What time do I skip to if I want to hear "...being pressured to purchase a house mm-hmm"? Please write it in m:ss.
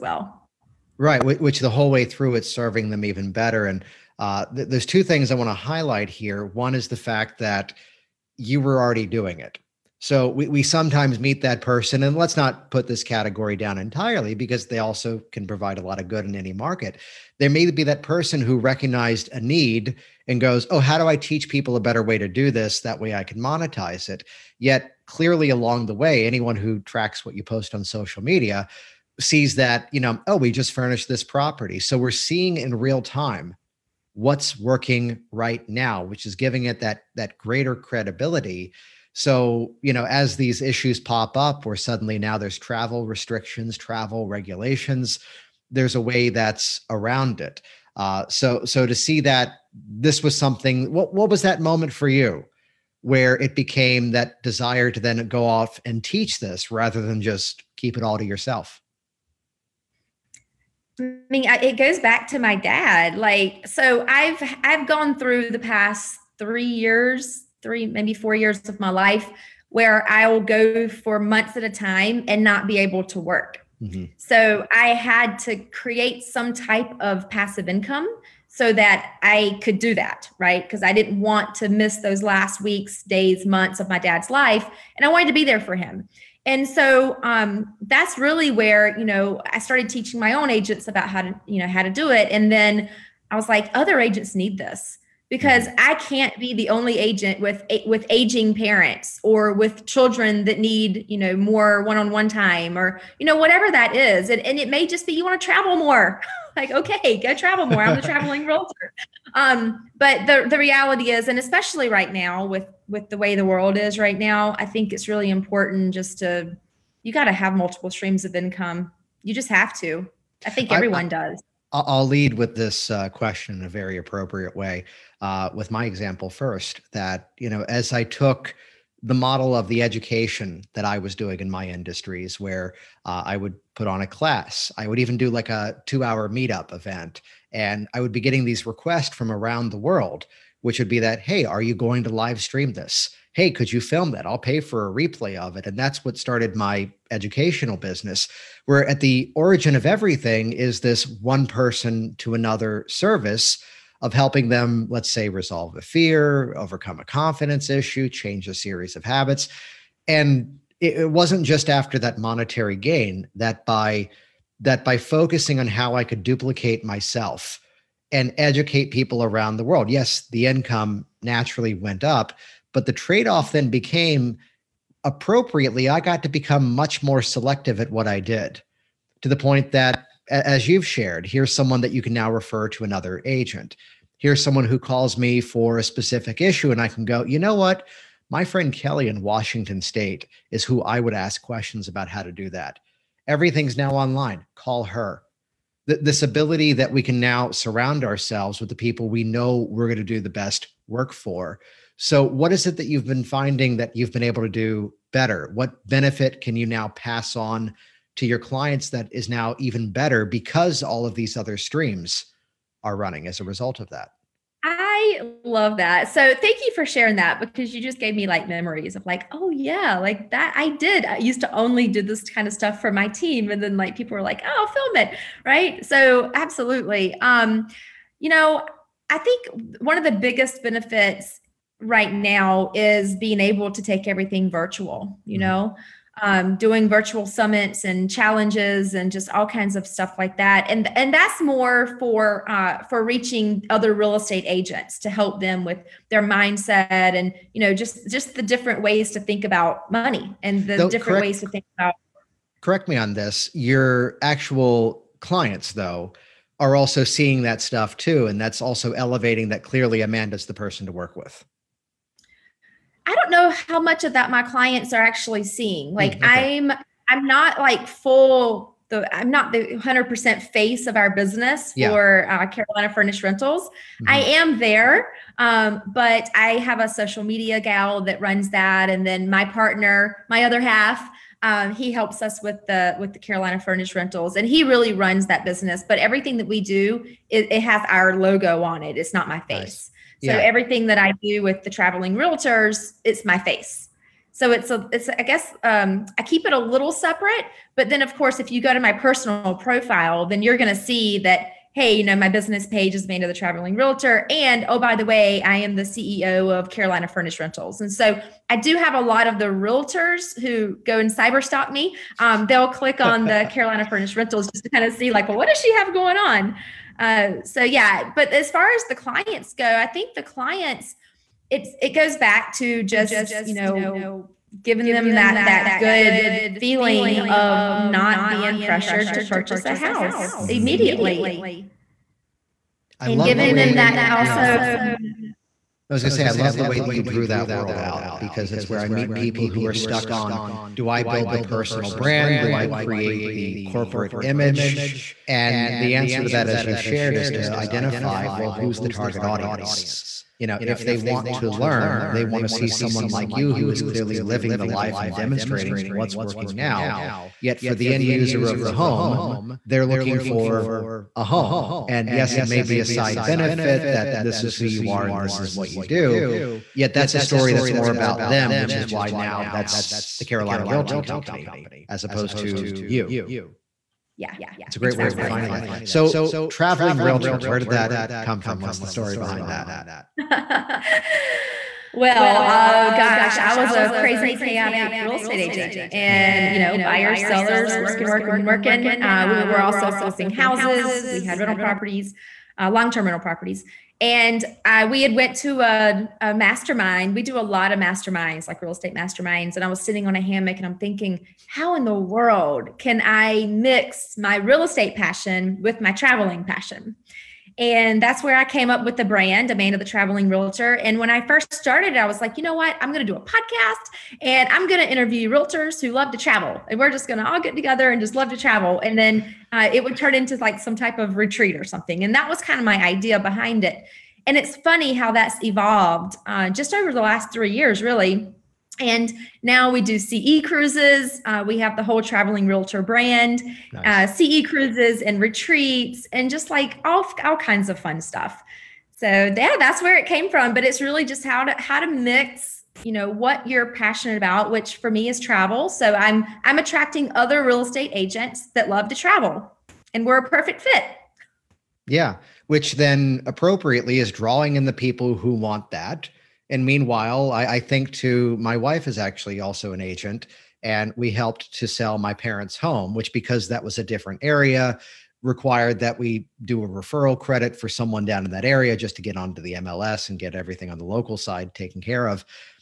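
5:28.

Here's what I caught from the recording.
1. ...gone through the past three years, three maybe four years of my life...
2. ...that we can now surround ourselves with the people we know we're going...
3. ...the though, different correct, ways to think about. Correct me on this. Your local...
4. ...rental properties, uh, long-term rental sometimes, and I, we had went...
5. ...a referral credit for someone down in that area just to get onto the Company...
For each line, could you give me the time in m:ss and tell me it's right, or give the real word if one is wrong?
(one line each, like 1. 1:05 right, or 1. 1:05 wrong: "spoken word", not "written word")
1. 1:04 right
2. 3:16 right
3. 4:10 wrong: "actual", not "local"
4. 6:31 wrong: "properties", not "sometimes"
5. 7:46 wrong: "MLS", not "Company".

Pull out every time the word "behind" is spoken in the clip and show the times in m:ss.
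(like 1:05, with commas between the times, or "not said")
6:19, 7:03.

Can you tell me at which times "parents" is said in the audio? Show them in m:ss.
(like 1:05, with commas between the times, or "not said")
1:38, 7:42.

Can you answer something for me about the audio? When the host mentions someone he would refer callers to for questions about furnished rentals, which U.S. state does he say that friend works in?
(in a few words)
Washington State.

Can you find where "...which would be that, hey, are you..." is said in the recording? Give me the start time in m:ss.
2:20.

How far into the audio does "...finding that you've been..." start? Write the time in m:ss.
3:23.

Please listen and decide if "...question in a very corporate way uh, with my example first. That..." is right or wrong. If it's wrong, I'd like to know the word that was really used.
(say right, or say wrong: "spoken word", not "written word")
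wrong: "appropriate", not "corporate".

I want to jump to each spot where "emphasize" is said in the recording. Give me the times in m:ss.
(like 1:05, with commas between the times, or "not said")
not said.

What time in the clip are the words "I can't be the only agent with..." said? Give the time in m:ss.
1:35.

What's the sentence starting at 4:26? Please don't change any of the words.
I'm I'm not like full the I'm not the 100% face of our business yeah.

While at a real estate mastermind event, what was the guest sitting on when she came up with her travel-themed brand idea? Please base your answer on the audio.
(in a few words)
a hammock.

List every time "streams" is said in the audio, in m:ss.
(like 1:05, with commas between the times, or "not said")
1:57, 2:22, 3:31.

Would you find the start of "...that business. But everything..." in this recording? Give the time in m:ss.
4:45.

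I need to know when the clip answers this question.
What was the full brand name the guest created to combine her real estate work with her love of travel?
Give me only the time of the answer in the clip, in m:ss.
6:49.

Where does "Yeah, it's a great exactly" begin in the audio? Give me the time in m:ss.
6:14.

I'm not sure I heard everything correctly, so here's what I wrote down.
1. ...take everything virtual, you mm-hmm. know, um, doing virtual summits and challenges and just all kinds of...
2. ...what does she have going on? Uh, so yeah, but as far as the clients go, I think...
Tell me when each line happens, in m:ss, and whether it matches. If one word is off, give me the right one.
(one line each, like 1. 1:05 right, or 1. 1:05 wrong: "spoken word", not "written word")
1. 3:53 right
2. 5:15 right.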